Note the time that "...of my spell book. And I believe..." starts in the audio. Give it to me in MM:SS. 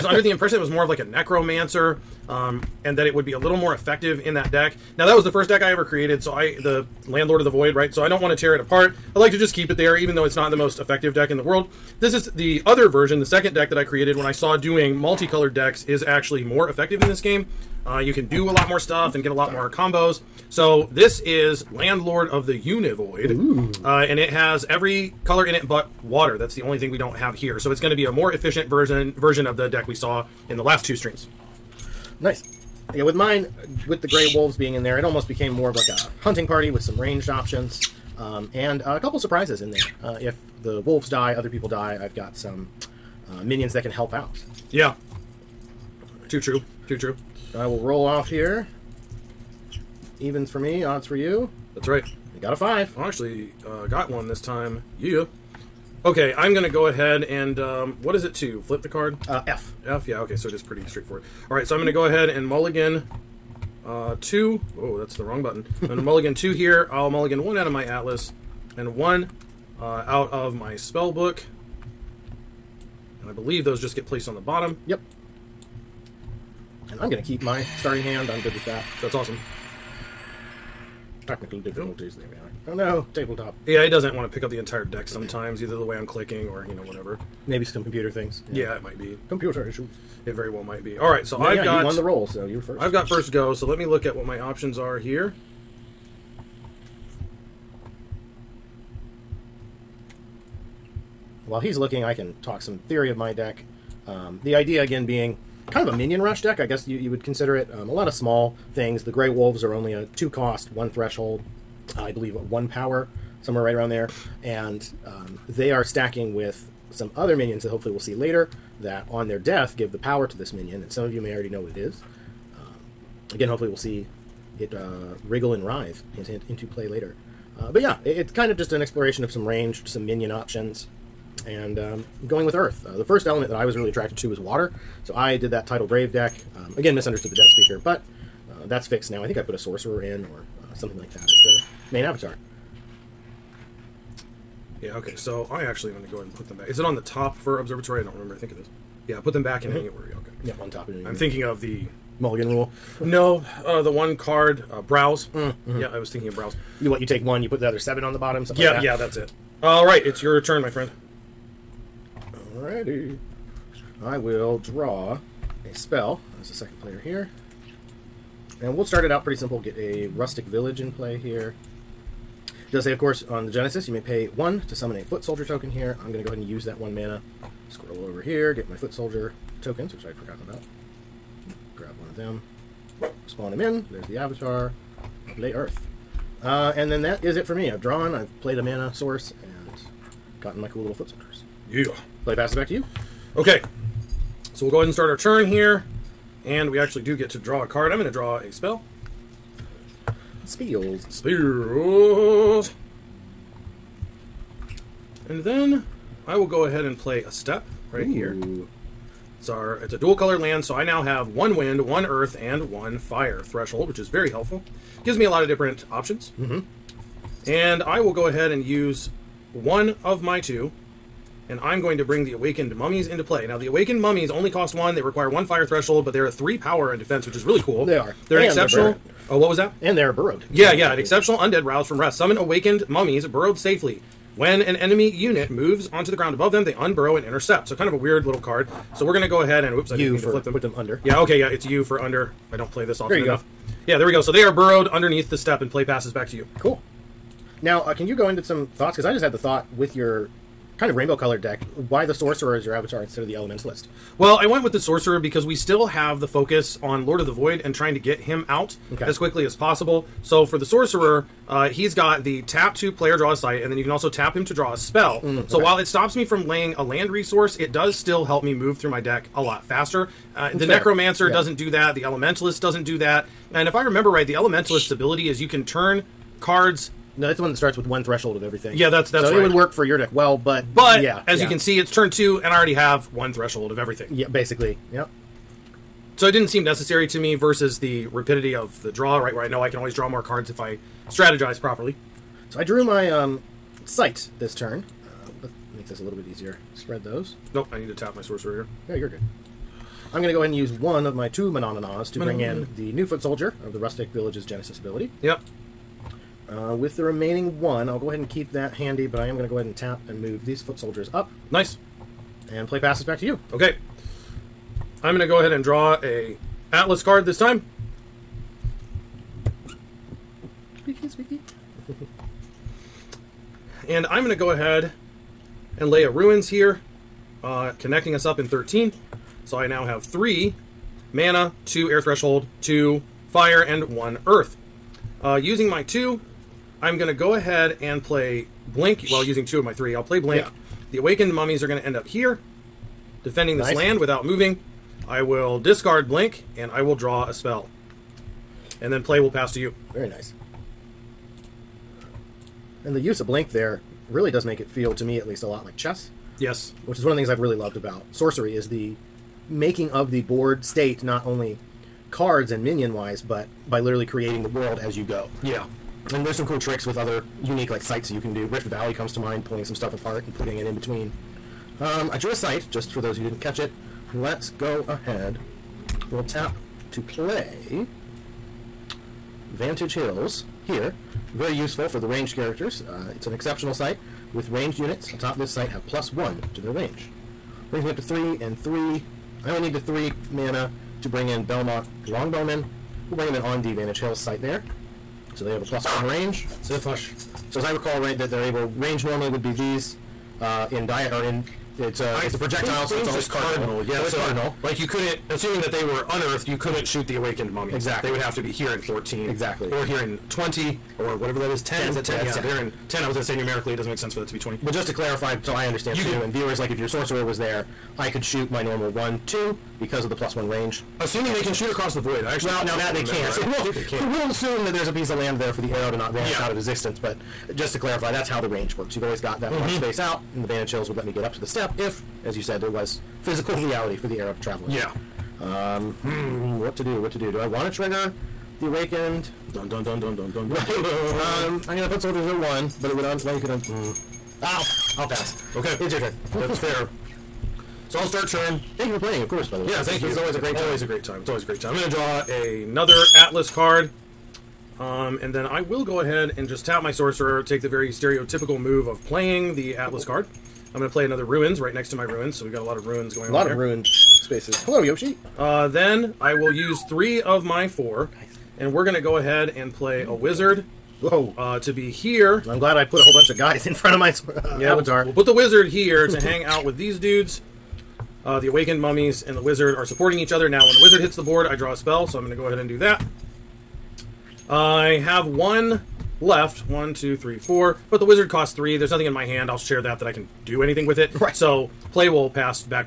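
01:10.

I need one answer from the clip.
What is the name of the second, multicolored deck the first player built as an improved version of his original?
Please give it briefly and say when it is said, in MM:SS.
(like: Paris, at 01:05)
Landlord of the Univoid, at 00:21.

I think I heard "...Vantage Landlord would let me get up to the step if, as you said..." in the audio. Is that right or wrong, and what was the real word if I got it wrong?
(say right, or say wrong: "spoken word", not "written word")
wrong: "Hills", not "Landlord".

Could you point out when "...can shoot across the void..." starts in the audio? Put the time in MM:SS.
07:01.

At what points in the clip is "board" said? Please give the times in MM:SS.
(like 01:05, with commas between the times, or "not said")
06:00, 08:01.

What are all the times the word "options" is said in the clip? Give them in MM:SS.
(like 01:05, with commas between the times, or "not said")
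00:37, 01:34, 02:10, 03:35.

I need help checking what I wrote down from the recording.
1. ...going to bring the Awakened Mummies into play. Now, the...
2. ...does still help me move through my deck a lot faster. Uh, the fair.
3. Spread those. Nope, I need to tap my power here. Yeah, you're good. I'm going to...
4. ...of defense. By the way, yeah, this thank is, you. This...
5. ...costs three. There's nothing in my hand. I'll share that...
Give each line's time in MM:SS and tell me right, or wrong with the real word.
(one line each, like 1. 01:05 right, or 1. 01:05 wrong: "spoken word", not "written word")
1. 03:41 right
2. 04:27 right
3. 04:56 wrong: "sorcerer", not "power"
4. 07:29 wrong: "course", not "defense"
5. 08:08 right.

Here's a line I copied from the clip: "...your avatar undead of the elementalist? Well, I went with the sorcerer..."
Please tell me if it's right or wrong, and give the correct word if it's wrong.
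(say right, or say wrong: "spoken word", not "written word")
wrong: "instead", not "undead".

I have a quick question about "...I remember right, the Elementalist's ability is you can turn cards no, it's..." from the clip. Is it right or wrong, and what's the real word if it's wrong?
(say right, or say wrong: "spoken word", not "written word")
right.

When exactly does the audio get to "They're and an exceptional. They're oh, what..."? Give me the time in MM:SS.
03:48.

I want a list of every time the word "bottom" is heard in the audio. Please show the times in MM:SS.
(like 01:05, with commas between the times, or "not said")
01:14, 02:38.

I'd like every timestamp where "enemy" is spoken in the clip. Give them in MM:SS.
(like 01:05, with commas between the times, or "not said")
03:54.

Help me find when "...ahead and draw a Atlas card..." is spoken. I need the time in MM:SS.
05:15.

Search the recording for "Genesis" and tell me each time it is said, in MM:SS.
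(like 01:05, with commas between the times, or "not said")
02:53, 05:04.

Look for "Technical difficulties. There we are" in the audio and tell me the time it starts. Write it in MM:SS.
01:21.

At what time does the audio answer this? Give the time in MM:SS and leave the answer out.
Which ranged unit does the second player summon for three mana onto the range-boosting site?
06:31.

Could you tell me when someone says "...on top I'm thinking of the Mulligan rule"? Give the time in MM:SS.
02:30.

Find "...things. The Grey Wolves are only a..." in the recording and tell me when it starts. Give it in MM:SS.
01:48.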